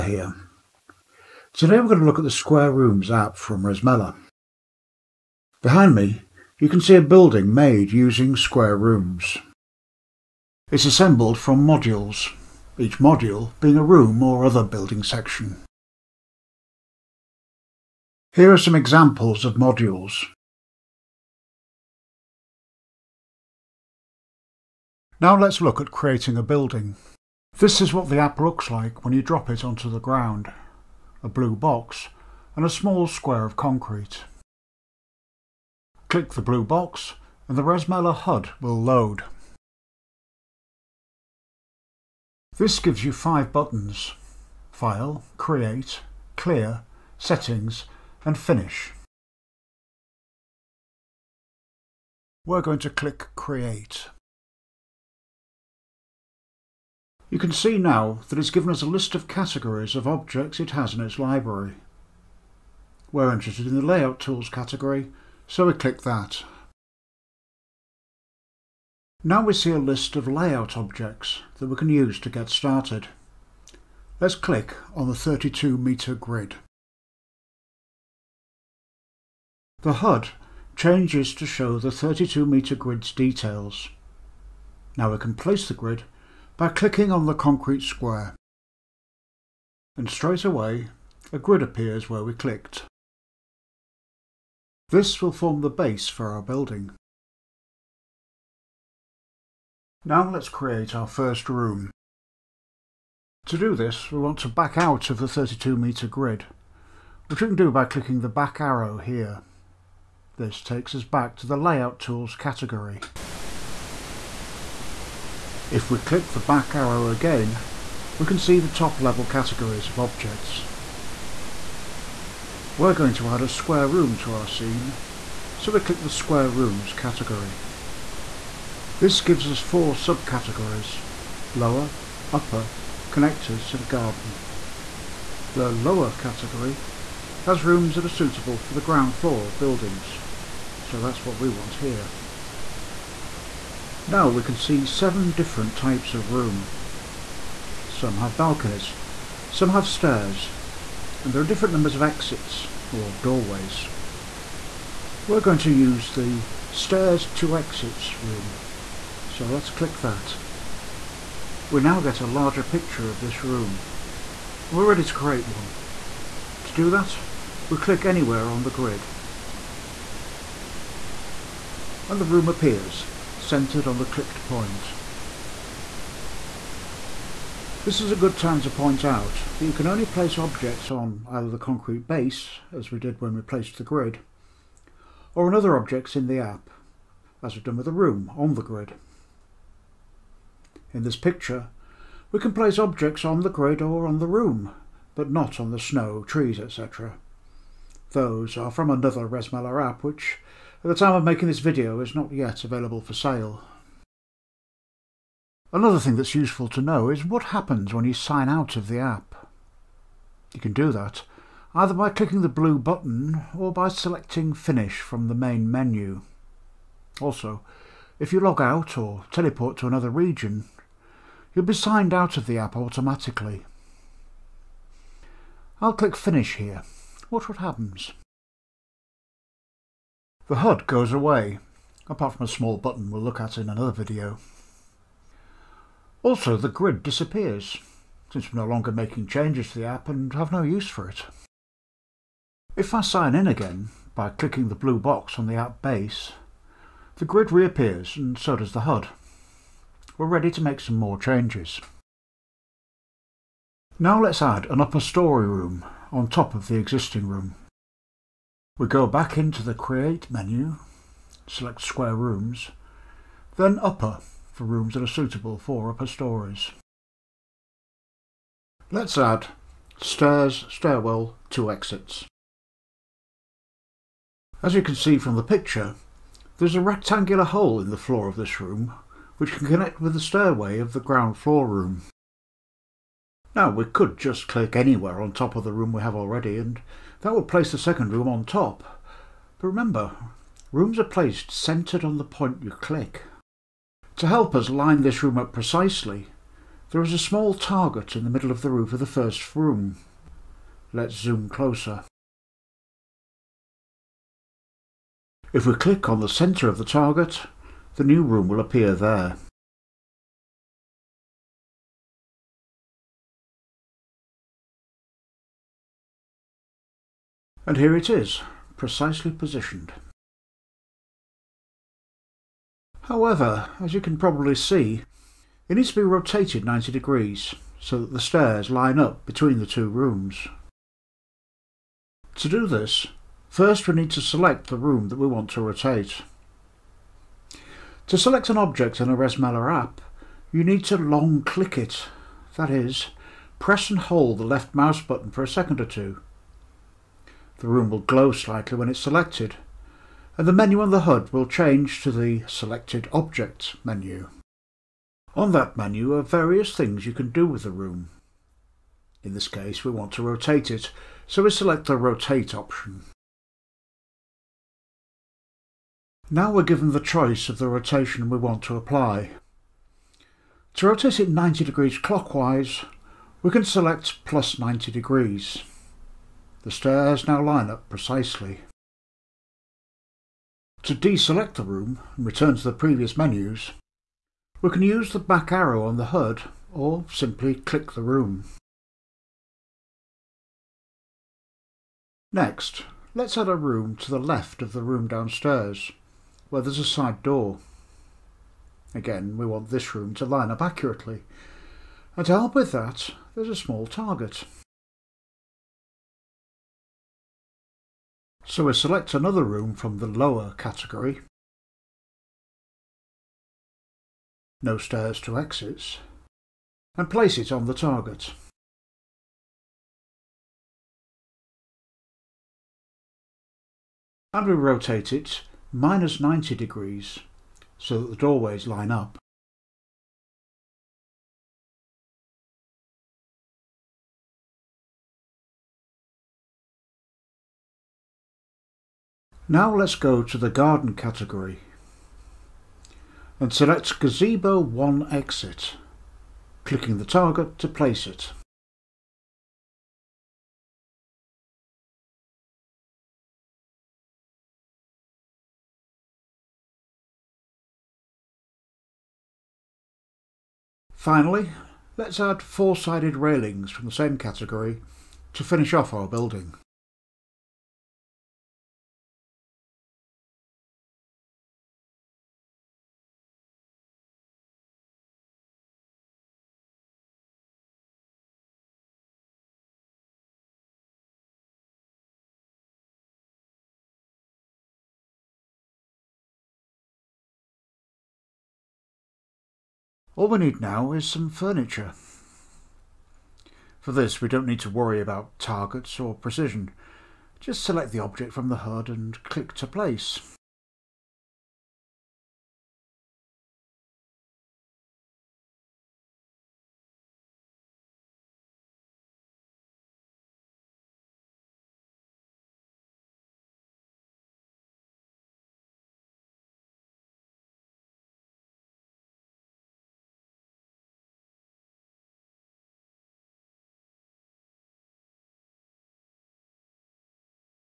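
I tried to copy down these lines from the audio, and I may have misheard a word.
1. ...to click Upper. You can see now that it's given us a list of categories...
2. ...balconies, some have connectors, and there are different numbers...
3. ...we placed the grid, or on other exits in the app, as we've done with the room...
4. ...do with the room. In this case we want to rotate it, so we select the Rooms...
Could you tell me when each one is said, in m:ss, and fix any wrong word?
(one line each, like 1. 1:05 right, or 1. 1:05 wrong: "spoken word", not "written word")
1. 0:52 wrong: "Create", not "Upper"
2. 2:28 wrong: "stairs", not "connectors"
3. 3:03 wrong: "objects", not "exits"
4. 5:57 wrong: "Rotate", not "Rooms".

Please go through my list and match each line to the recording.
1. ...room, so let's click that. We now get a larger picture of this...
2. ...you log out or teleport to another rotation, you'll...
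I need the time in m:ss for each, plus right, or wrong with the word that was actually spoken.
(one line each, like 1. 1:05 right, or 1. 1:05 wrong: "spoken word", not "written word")
1. 2:38 right
2. 3:38 wrong: "region", not "rotation".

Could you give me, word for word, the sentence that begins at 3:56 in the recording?
Also, the grid disappears, since we're no longer making changes to the app and have no use for it.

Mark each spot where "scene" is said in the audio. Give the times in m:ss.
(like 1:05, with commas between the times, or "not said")
2:04.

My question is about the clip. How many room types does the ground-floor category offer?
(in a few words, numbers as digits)
7.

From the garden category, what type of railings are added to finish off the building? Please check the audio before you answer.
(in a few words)
Four-sided railings.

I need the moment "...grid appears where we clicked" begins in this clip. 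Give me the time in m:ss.
1:31.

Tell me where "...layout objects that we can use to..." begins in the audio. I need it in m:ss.
1:10.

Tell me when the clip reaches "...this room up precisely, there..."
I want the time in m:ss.
4:55.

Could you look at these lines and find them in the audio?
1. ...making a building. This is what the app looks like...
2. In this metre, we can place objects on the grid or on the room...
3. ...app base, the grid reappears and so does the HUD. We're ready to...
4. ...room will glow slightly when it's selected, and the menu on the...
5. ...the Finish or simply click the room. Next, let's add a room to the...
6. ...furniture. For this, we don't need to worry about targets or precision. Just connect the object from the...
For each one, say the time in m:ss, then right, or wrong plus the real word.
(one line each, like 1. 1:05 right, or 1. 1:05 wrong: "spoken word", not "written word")
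1. 0:25 wrong: "creating", not "making"
2. 3:10 wrong: "picture", not "metre"
3. 4:05 right
4. 5:47 right
5. 6:25 wrong: "HUD", not "Finish"
6. 8:11 wrong: "select", not "connect".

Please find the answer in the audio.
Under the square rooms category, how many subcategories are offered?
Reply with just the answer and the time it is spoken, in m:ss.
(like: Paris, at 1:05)
4, at 2:09.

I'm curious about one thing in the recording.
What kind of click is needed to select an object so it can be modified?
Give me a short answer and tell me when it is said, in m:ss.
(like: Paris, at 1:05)
Long click, at 5:40.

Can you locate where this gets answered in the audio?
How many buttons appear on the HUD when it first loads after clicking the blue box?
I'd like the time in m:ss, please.
0:43.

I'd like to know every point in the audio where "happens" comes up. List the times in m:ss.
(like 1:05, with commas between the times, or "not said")
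3:27, 3:47.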